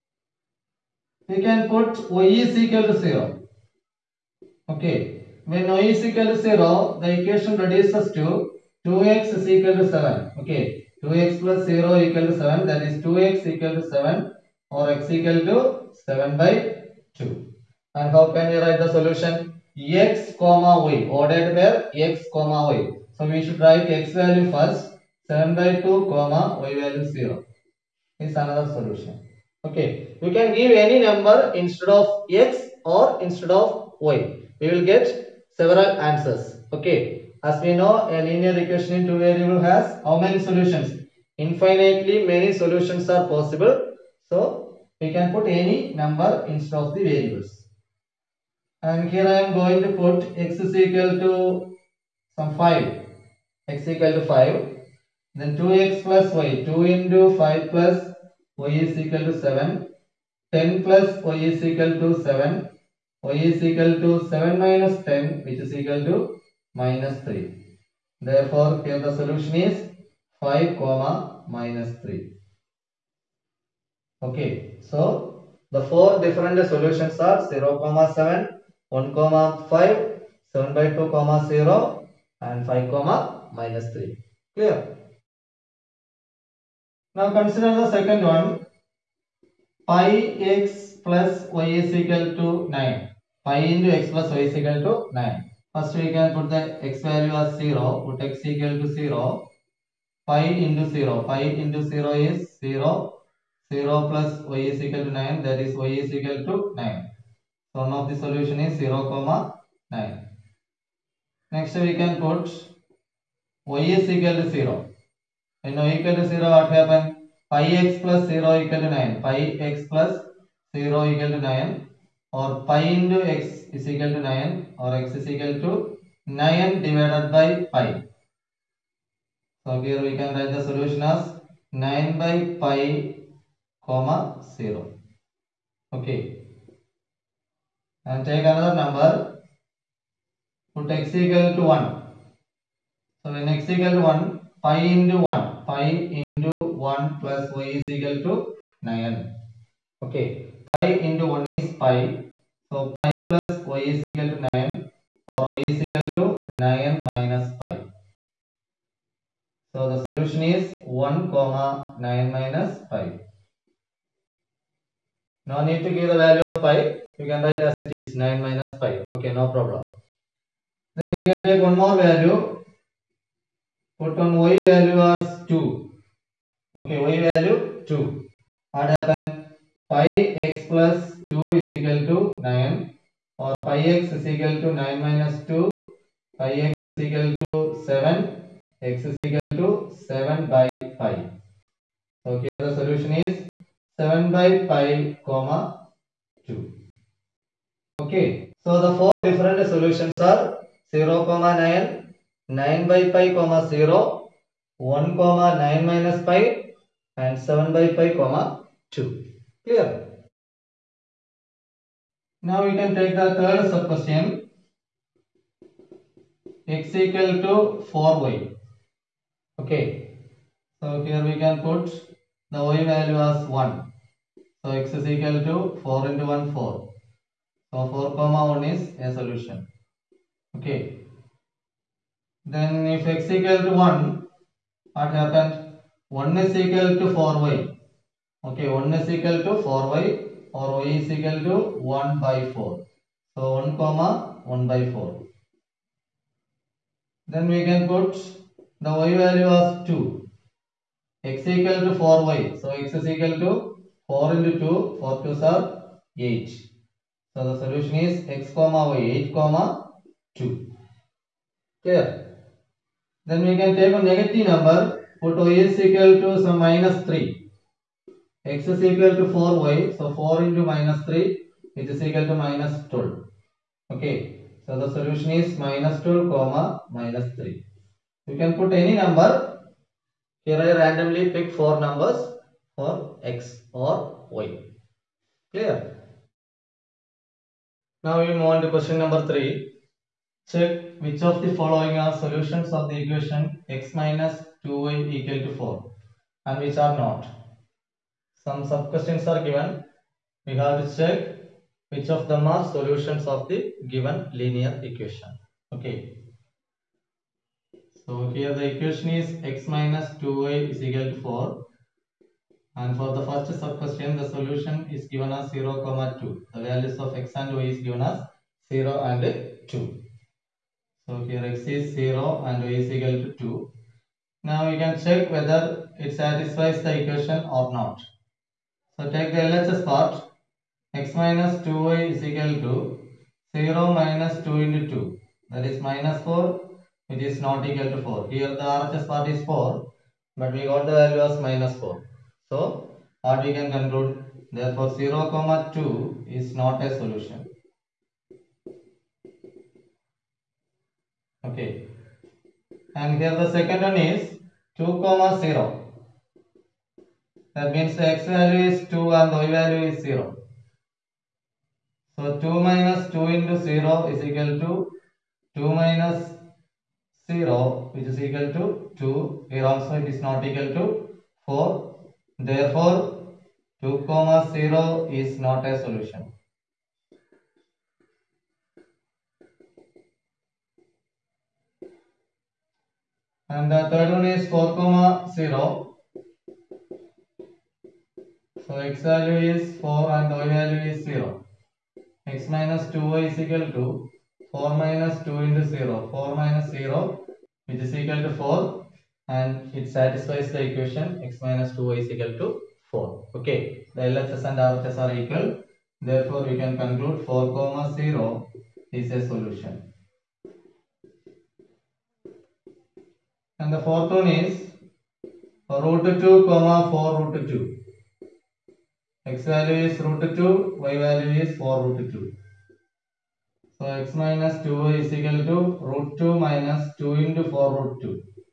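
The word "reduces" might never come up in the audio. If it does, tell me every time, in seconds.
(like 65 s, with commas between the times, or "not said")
7 s.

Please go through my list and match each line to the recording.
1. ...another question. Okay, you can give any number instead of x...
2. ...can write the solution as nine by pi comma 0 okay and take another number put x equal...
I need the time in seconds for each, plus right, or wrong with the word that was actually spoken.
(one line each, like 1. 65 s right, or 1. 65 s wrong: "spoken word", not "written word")
1. 28 s wrong: "solution", not "question"
2. 130 s right.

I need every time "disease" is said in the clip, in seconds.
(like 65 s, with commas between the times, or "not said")
not said.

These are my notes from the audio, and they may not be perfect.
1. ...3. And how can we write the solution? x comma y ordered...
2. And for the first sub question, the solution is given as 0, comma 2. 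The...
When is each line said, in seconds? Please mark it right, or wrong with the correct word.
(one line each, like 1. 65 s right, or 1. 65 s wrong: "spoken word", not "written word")
1. 17 s wrong: "2", not "3"
2. 312 s right.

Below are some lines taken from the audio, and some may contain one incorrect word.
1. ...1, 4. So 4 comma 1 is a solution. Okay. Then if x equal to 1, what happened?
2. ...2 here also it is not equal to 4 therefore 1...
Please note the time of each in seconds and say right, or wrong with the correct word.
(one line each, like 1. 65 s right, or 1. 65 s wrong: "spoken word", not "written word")
1. 226 s right
2. 368 s wrong: "2", not "1".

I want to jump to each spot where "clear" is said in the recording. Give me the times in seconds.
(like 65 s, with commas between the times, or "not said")
84 s, 209 s, 261 s, 285 s.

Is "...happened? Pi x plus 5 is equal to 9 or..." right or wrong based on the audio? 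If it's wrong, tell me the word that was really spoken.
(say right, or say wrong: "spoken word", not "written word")
wrong: "2", not "5".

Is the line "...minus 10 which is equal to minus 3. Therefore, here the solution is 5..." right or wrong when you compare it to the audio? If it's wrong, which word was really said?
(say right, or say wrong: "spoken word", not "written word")
right.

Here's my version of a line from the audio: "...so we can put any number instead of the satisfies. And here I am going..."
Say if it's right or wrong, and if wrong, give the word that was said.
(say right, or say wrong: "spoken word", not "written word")
wrong: "variables", not "satisfies".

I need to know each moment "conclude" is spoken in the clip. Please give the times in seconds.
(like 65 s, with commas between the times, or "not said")
343 s, 406 s.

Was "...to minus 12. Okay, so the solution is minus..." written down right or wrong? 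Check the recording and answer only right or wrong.
right.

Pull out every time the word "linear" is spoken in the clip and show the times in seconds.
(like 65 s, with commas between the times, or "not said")
38 s, 304 s.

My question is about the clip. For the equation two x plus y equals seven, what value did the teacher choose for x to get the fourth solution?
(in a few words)
5.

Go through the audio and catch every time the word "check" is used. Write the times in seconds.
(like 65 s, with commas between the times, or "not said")
290 s, 300 s, 325 s.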